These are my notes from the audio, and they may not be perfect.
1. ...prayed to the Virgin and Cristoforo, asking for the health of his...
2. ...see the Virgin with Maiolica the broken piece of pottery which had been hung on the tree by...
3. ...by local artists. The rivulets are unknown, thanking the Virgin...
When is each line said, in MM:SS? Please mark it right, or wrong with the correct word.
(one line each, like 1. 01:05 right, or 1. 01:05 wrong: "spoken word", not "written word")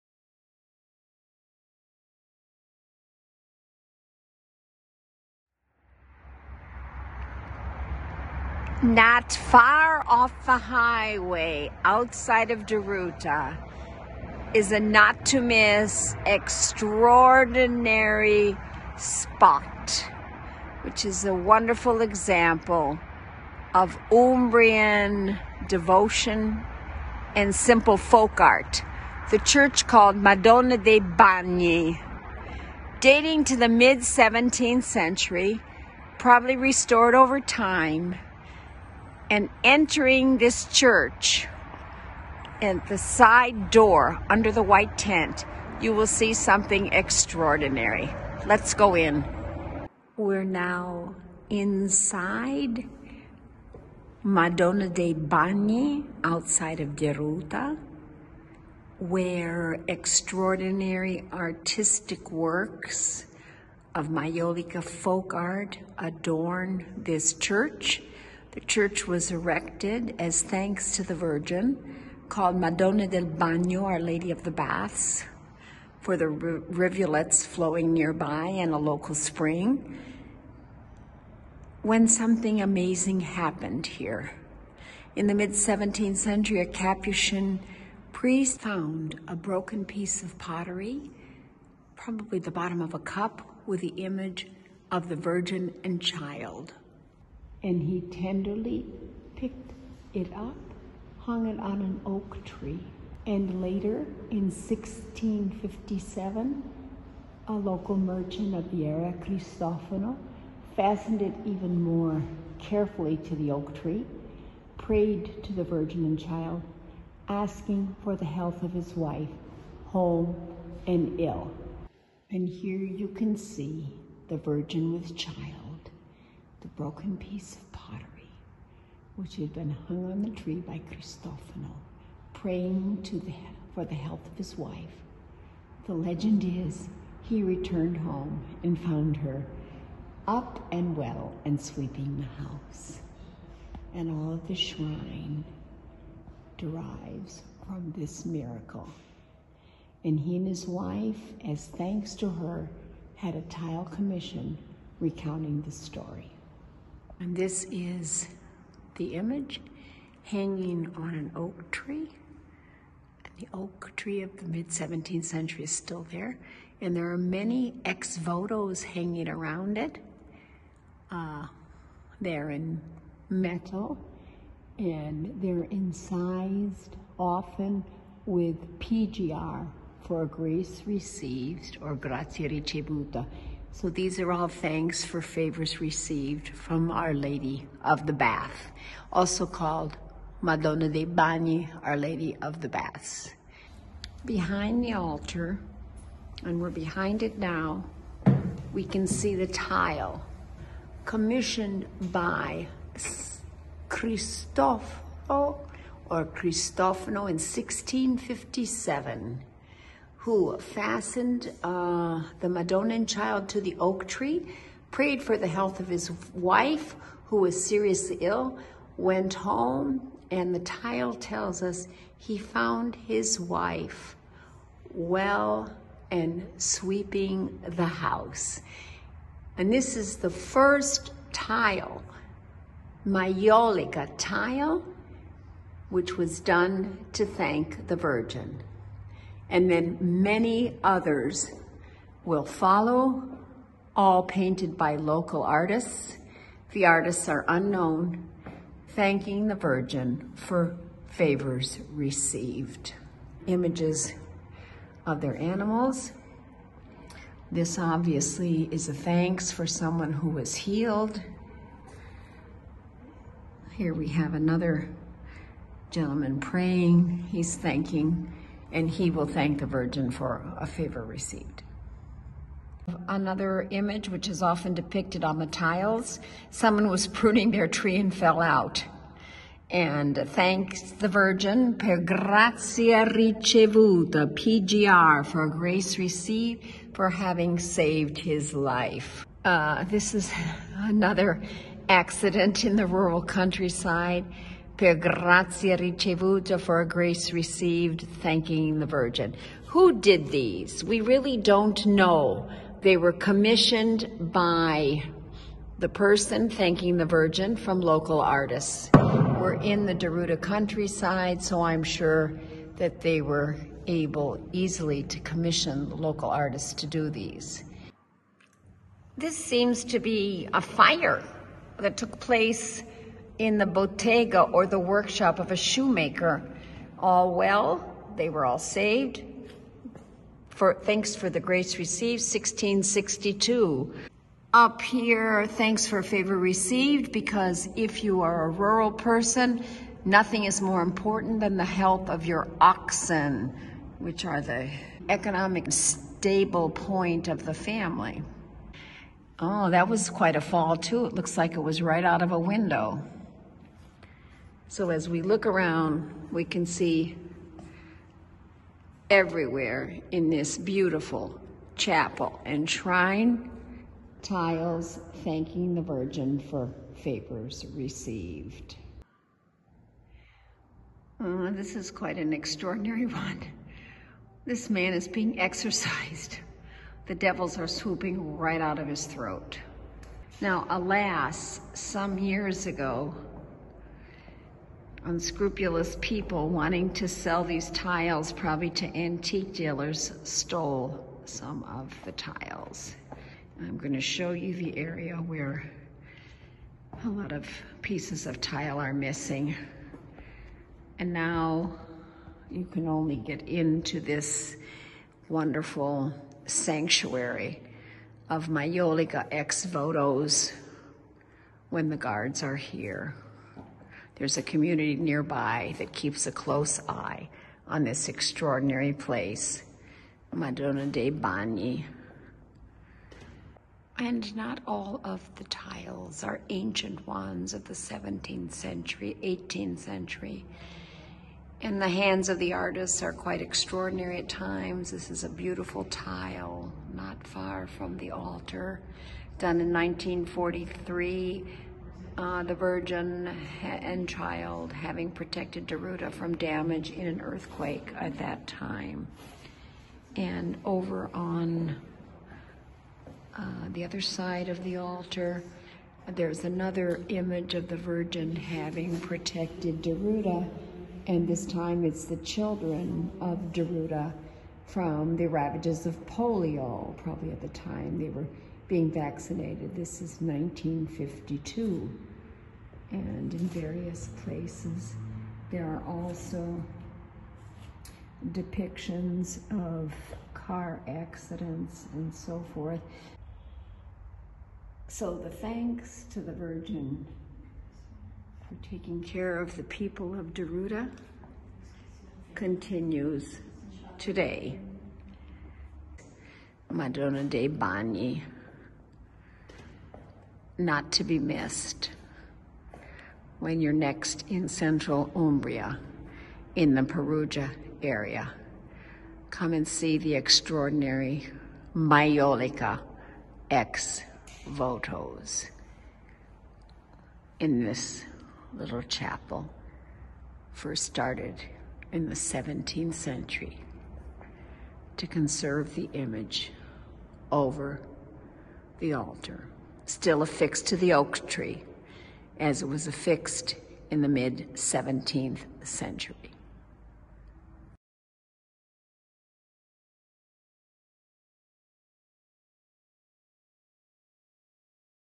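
1. 01:54 wrong: "Child", not "Cristoforo"
2. 02:03 wrong: "Child", not "Maiolica"
3. 04:04 wrong: "artists", not "rivulets".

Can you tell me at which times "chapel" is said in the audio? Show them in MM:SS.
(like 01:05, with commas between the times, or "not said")
06:01, 08:38.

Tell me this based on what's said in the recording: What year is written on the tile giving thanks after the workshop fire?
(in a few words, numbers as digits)
1662.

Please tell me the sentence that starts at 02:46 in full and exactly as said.
And there are many ex votos hanging around it.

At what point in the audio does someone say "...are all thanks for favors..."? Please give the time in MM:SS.
03:04.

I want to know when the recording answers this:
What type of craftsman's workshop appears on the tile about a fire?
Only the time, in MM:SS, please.
05:25.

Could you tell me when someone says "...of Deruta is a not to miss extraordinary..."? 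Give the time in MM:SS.
00:12.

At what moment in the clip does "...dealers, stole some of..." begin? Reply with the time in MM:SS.
06:29.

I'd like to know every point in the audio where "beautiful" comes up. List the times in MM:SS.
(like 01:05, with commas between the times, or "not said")
06:00, 07:15.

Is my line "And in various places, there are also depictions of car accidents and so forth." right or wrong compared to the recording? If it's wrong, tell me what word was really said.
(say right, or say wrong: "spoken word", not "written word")
right.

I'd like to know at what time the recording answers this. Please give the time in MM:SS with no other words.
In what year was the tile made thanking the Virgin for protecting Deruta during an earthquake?
07:19.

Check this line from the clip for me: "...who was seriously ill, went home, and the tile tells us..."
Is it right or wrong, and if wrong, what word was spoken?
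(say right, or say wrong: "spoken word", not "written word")
right.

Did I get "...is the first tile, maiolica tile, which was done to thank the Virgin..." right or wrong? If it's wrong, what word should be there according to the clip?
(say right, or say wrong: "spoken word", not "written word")
right.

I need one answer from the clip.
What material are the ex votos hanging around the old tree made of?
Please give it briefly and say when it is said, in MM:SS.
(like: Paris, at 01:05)
Metal, at 02:53.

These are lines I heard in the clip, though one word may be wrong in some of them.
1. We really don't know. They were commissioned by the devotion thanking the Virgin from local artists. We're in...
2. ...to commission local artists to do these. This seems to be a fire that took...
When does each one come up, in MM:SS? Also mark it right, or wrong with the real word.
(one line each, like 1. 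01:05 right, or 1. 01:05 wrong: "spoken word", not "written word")
1. 05:00 wrong: "person", not "devotion"
2. 05:15 right.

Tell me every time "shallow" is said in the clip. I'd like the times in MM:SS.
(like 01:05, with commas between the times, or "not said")
not said.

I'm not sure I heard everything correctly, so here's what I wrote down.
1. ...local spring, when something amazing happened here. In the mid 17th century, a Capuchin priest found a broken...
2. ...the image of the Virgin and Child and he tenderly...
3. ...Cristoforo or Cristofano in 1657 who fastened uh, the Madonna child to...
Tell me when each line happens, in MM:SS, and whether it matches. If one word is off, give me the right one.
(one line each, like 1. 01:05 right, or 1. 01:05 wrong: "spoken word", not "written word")
1. 01:18 right
2. 01:33 right
3. 03:23 right.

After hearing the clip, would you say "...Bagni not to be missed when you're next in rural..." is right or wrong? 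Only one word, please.
wrong.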